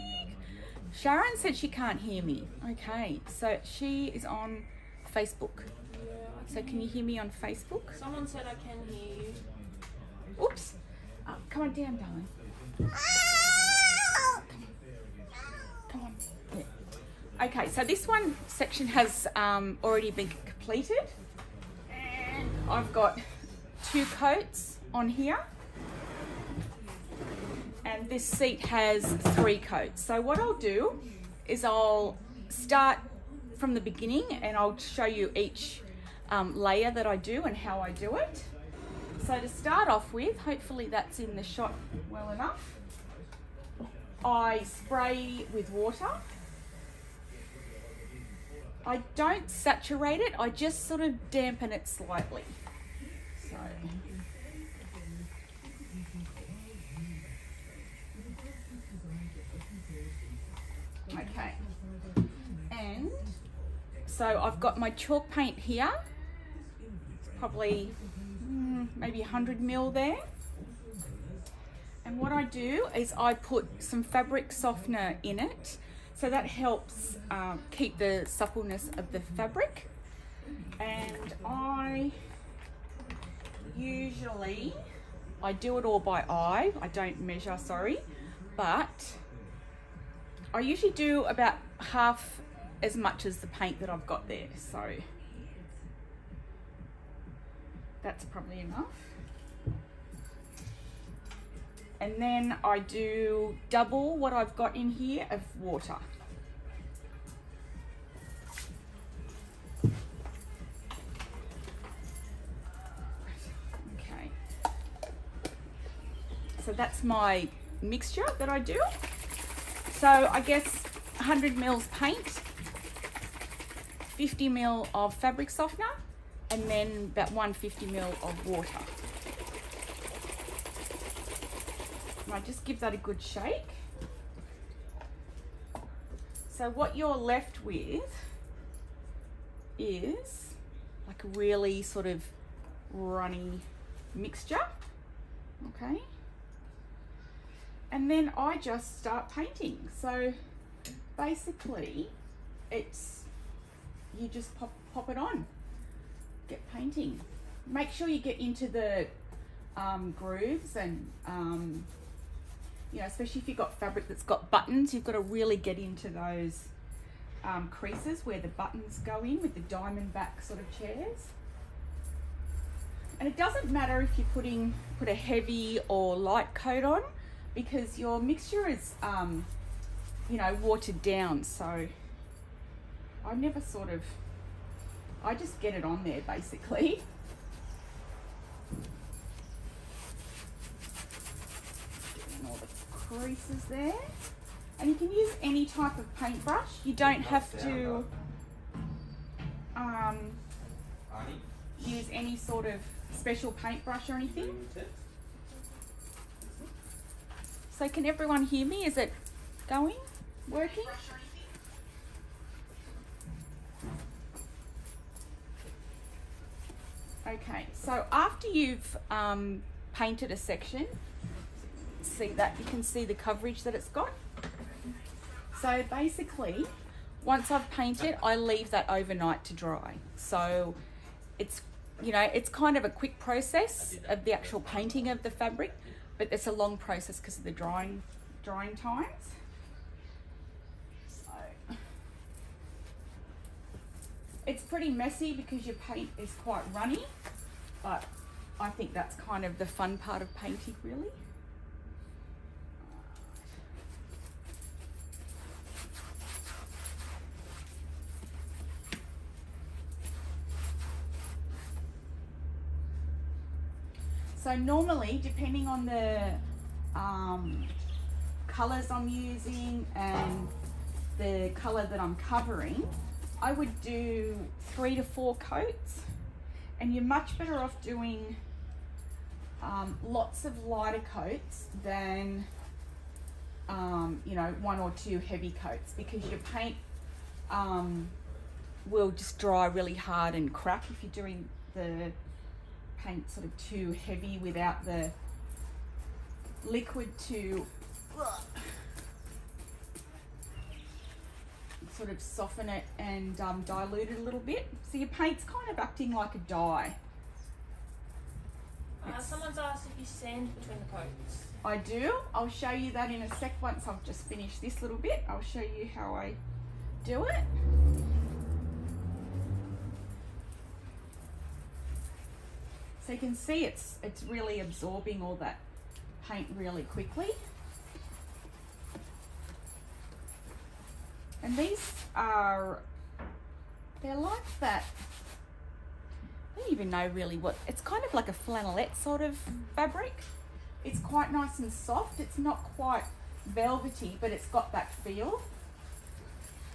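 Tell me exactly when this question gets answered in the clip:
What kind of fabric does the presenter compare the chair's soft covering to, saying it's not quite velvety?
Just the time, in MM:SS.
05:38.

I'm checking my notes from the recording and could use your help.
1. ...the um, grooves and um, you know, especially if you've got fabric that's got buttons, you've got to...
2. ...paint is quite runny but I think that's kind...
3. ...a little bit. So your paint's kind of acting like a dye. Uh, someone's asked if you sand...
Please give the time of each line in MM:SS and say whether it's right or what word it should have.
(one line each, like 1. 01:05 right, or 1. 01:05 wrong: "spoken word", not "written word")
1. 02:38 right
2. 04:05 right
3. 05:04 right.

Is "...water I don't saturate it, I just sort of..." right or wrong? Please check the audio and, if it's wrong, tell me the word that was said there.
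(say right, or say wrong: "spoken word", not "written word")
right.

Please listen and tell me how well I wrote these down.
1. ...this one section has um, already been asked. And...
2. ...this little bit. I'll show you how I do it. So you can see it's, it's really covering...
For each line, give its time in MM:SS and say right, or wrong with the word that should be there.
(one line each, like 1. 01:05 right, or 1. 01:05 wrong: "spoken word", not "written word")
1. 00:17 wrong: "completed", not "asked"
2. 05:14 wrong: "absorbing", not "covering".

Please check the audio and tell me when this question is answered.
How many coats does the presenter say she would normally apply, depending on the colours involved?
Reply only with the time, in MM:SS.
04:34.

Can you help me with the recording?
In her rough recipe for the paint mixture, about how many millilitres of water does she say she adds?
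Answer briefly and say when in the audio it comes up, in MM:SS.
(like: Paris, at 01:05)
150 mil, at 02:07.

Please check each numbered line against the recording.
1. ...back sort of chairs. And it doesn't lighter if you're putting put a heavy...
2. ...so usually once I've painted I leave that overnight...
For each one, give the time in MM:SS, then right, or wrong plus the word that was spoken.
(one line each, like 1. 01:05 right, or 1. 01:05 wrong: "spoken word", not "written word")
1. 02:50 wrong: "matter", not "lighter"
2. 03:45 wrong: "basically", not "usually".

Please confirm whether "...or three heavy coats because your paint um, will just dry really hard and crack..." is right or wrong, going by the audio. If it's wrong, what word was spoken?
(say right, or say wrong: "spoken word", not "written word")
wrong: "two", not "three".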